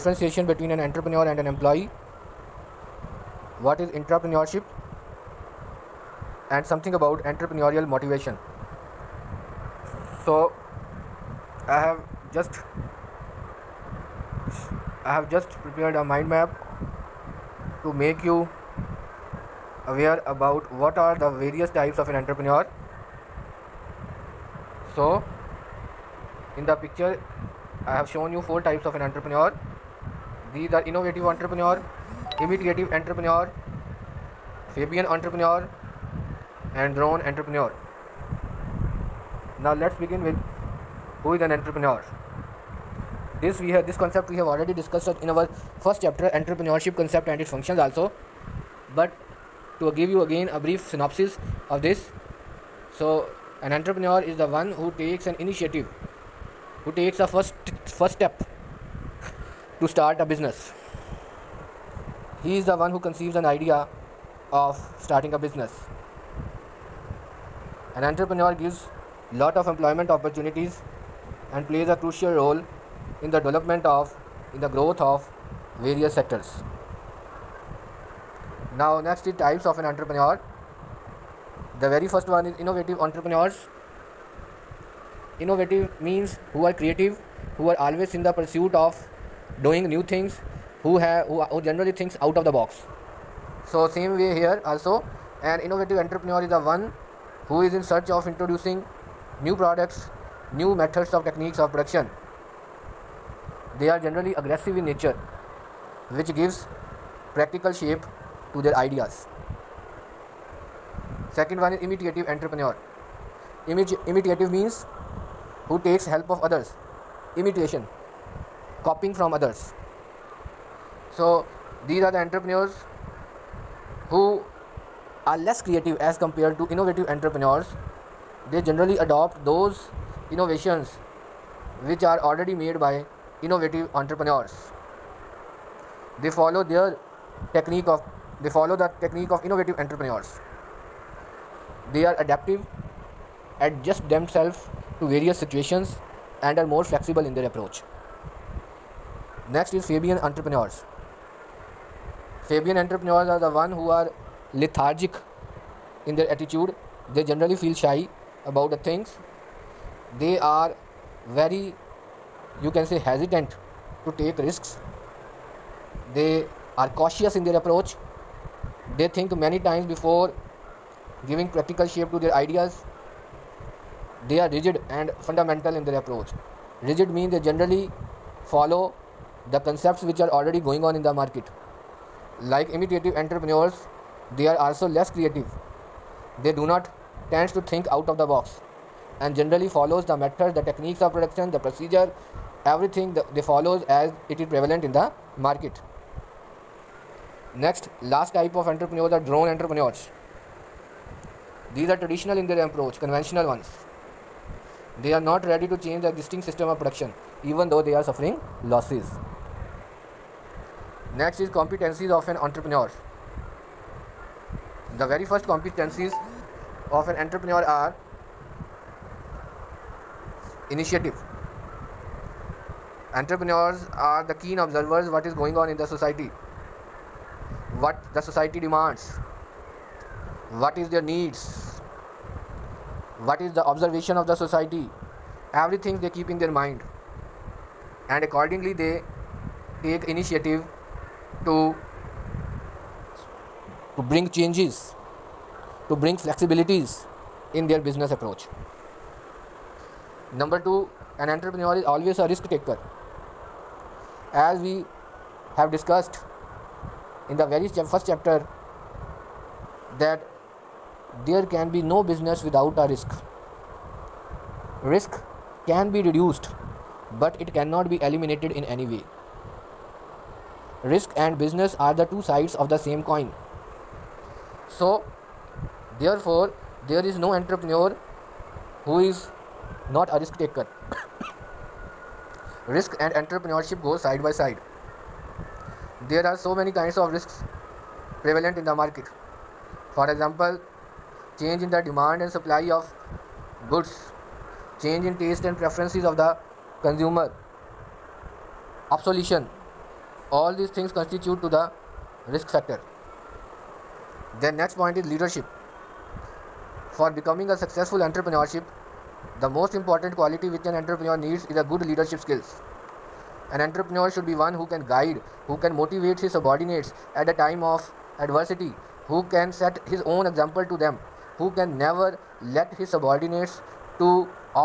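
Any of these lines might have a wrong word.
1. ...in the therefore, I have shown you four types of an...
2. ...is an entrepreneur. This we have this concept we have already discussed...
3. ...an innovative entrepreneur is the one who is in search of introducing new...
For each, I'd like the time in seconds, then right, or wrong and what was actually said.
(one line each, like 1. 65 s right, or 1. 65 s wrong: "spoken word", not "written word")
1. 26 s wrong: "picture", not "therefore"
2. 41 s right
3. 95 s right.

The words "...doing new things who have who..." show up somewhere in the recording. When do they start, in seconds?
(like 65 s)
89 s.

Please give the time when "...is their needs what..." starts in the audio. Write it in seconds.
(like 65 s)
230 s.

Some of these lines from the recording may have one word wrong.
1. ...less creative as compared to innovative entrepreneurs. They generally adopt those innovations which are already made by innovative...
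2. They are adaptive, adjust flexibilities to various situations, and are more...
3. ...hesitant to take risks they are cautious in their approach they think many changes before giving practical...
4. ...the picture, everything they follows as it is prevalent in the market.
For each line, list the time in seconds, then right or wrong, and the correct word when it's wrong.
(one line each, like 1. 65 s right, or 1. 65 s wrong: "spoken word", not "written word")
1. 125 s right
2. 141 s wrong: "themselves", not "flexibilities"
3. 162 s wrong: "times", not "changes"
4. 191 s wrong: "procedure", not "picture".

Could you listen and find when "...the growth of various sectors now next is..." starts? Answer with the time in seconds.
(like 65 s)
74 s.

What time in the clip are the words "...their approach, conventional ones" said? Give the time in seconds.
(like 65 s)
202 s.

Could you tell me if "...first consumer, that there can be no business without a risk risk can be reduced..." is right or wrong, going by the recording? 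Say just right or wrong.
wrong.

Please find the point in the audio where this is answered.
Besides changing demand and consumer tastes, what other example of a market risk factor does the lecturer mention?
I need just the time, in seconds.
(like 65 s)
298 s.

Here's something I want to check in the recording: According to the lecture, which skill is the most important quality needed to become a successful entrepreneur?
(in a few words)
Leadership skills.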